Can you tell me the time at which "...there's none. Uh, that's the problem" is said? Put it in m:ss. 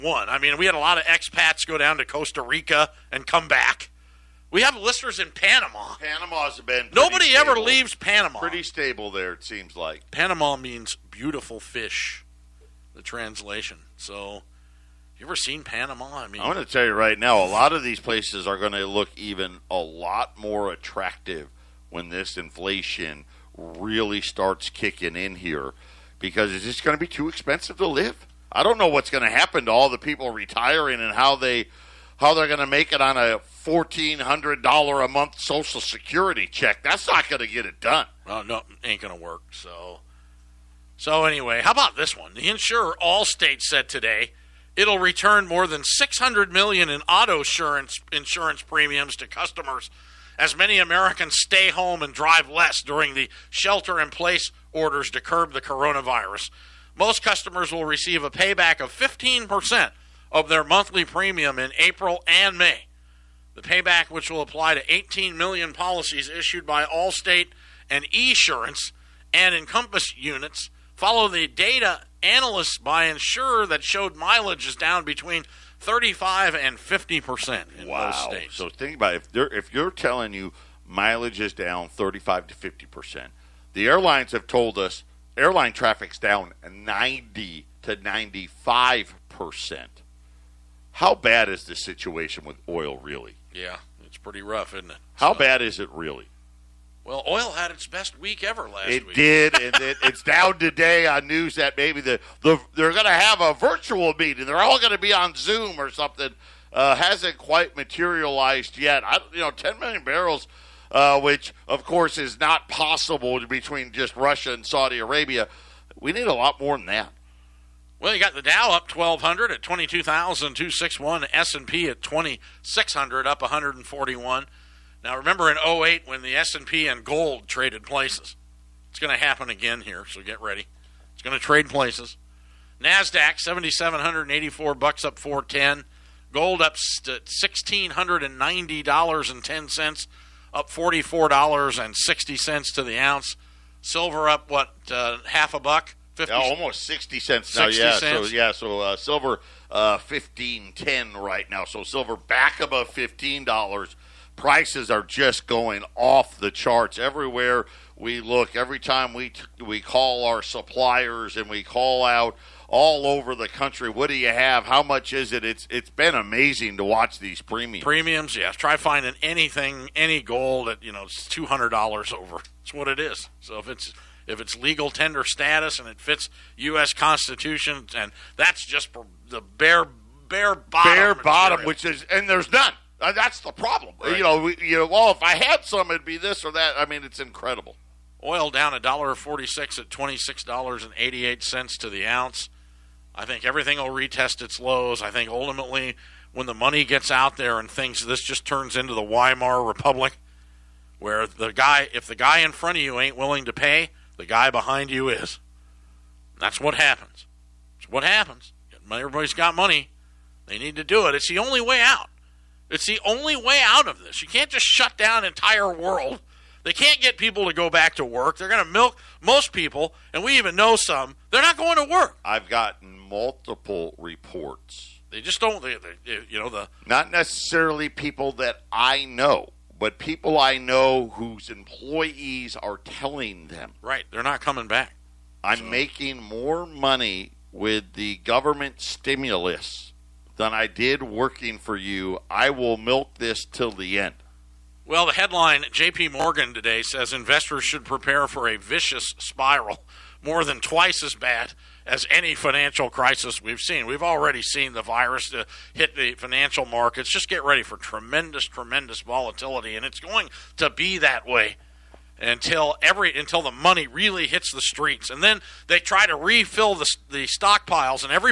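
3:02.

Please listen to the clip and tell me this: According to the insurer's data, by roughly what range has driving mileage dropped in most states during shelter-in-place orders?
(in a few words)
35 to 50 percent.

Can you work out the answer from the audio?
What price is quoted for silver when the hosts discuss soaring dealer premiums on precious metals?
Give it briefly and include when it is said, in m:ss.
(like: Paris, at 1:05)
15.10, at 2:29.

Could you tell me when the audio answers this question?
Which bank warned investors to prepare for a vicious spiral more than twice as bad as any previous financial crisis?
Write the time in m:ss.
4:05.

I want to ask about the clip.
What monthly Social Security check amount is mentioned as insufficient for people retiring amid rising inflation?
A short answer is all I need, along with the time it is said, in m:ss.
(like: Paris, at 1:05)
$1,400, at 0:33.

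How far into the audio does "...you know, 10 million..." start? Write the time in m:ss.
1:49.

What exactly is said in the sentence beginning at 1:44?
They're all going to be on Zoom or something.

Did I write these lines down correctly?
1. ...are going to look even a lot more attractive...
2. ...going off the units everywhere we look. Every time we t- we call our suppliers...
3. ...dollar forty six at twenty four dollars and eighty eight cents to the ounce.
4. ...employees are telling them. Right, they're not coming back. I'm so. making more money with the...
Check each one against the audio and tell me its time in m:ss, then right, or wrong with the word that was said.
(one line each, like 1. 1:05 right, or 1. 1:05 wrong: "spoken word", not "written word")
1. 0:18 right
2. 2:35 wrong: "charts", not "units"
3. 3:08 wrong: "six", not "four"
4. 3:51 right.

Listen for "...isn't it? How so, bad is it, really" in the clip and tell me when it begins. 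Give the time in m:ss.
1:34.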